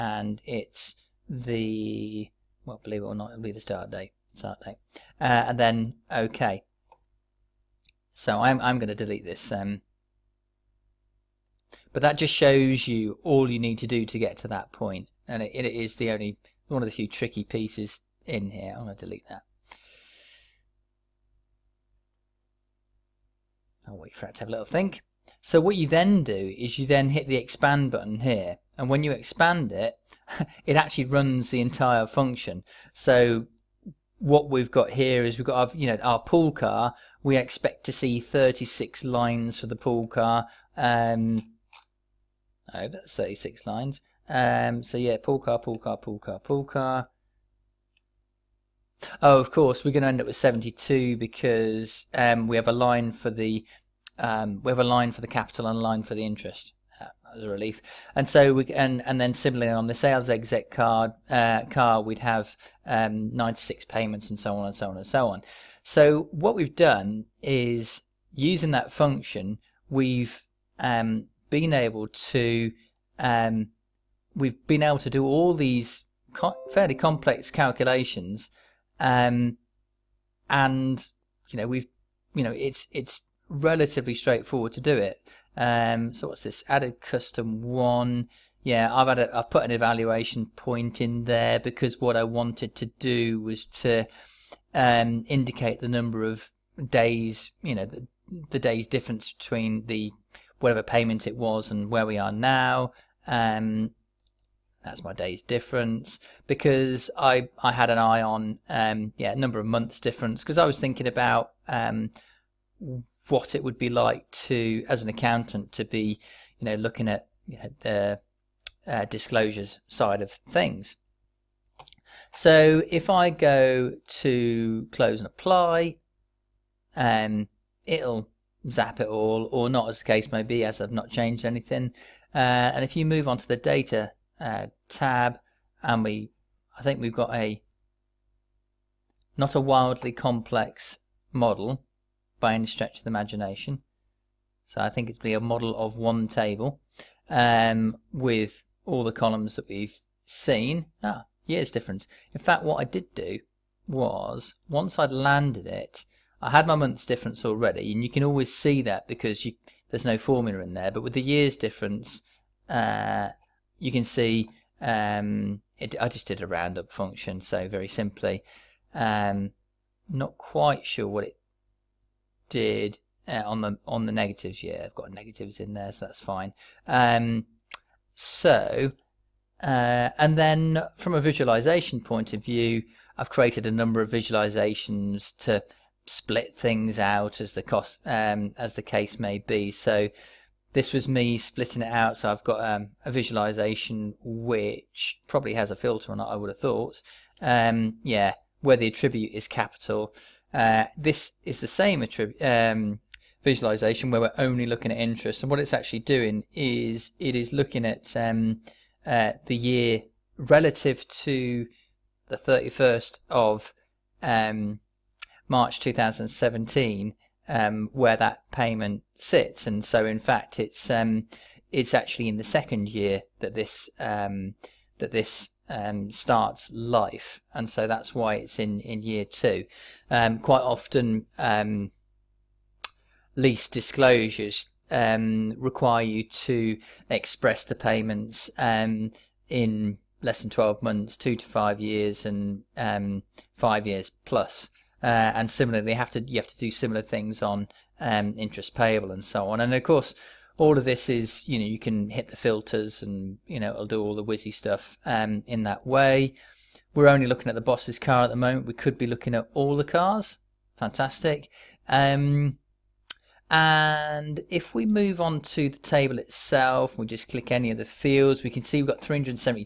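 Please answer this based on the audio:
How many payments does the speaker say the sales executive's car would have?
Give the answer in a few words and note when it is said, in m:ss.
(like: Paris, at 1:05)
96, at 1:03.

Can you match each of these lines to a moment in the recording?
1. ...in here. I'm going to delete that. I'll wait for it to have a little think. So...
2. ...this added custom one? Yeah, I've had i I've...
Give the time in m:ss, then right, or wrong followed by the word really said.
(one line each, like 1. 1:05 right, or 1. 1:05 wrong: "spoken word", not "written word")
1. 0:18 right
2. 1:26 right.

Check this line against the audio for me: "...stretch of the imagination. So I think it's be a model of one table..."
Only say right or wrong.
right.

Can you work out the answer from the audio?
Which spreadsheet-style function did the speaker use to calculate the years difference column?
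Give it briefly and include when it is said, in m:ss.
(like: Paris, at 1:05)
roundup, at 2:46.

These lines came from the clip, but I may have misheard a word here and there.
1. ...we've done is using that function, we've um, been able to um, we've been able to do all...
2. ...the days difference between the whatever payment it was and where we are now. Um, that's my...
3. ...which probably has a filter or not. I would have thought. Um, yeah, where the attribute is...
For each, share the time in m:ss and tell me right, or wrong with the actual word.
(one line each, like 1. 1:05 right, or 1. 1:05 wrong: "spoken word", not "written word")
1. 1:06 right
2. 1:38 right
3. 3:14 right.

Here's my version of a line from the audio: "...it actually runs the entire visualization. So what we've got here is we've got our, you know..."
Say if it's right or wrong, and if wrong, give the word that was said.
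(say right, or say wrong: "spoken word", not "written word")
wrong: "function", not "visualization".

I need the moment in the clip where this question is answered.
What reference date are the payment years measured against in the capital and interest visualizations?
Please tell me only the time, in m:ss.
3:32.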